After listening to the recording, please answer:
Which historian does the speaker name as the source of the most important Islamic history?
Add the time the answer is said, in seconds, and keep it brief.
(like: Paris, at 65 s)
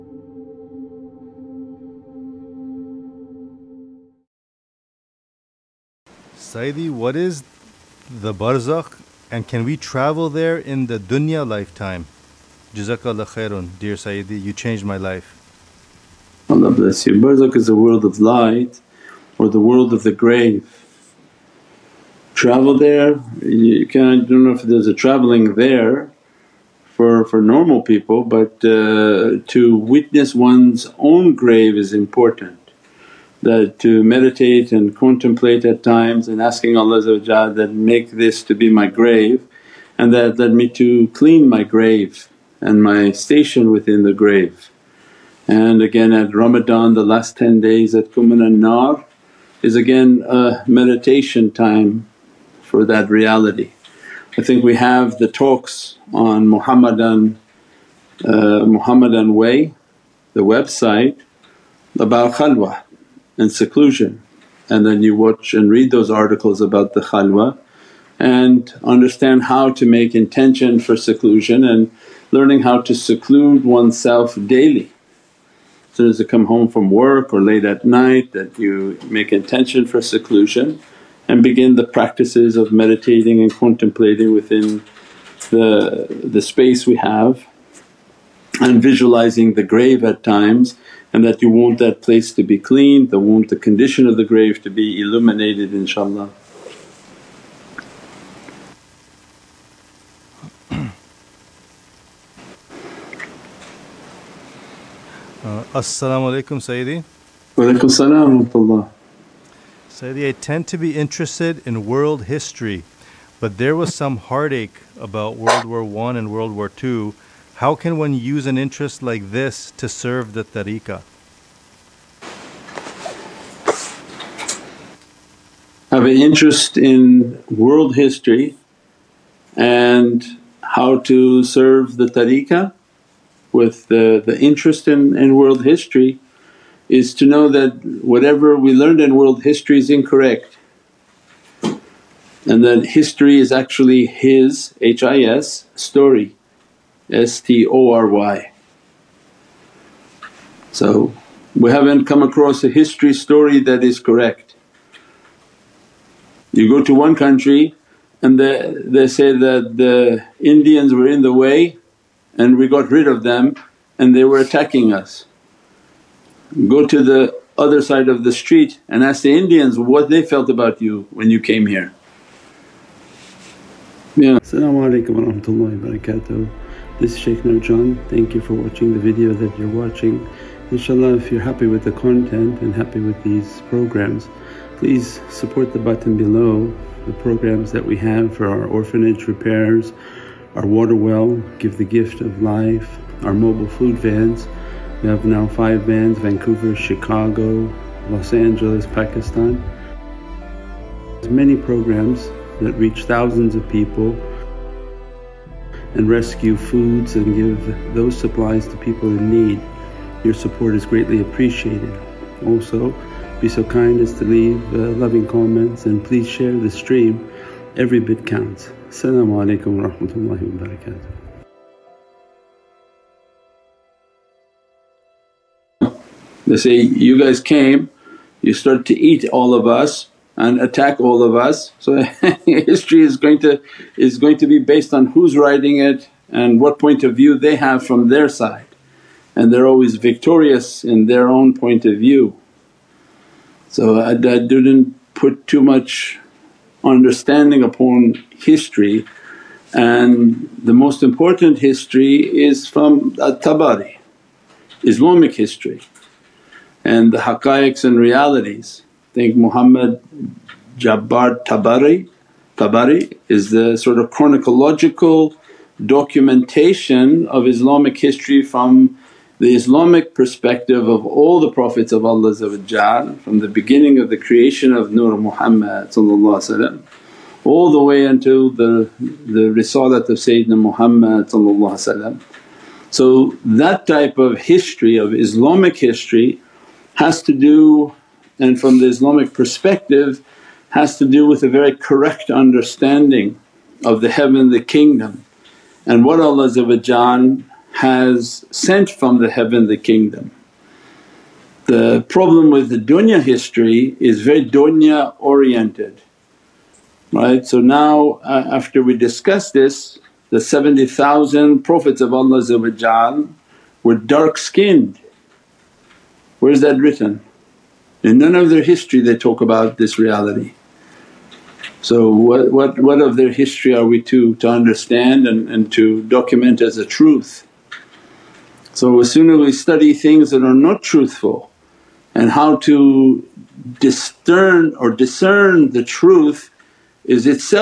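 at-Tabari, at 253 s.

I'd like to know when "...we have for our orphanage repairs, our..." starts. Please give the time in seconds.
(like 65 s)
187 s.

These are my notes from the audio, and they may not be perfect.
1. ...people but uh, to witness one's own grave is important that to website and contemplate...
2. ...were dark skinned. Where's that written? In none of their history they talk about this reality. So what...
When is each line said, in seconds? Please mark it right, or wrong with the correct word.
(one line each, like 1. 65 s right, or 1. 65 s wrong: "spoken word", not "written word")
1. 27 s wrong: "meditate", not "website"
2. 313 s right.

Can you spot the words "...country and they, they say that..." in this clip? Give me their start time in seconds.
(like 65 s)
157 s.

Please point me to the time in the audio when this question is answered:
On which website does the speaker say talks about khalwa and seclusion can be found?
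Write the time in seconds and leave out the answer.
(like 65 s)
58 s.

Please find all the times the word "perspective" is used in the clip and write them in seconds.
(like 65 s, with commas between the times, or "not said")
270 s, 289 s.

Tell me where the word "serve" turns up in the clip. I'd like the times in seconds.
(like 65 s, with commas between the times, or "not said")
119 s, 131 s.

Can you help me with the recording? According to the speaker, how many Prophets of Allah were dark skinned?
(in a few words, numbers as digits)
70,000.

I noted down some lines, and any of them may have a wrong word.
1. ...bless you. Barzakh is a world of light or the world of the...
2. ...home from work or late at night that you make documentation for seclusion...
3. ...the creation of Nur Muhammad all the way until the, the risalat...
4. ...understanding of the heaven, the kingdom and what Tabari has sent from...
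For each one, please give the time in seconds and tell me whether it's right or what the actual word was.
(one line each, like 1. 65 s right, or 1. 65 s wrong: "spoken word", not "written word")
1. 16 s right
2. 76 s wrong: "intention", not "documentation"
3. 274 s right
4. 292 s wrong: "Allah", not "Tabari".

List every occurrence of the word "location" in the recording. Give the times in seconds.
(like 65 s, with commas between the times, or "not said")
not said.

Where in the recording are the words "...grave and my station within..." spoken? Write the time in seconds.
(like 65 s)
41 s.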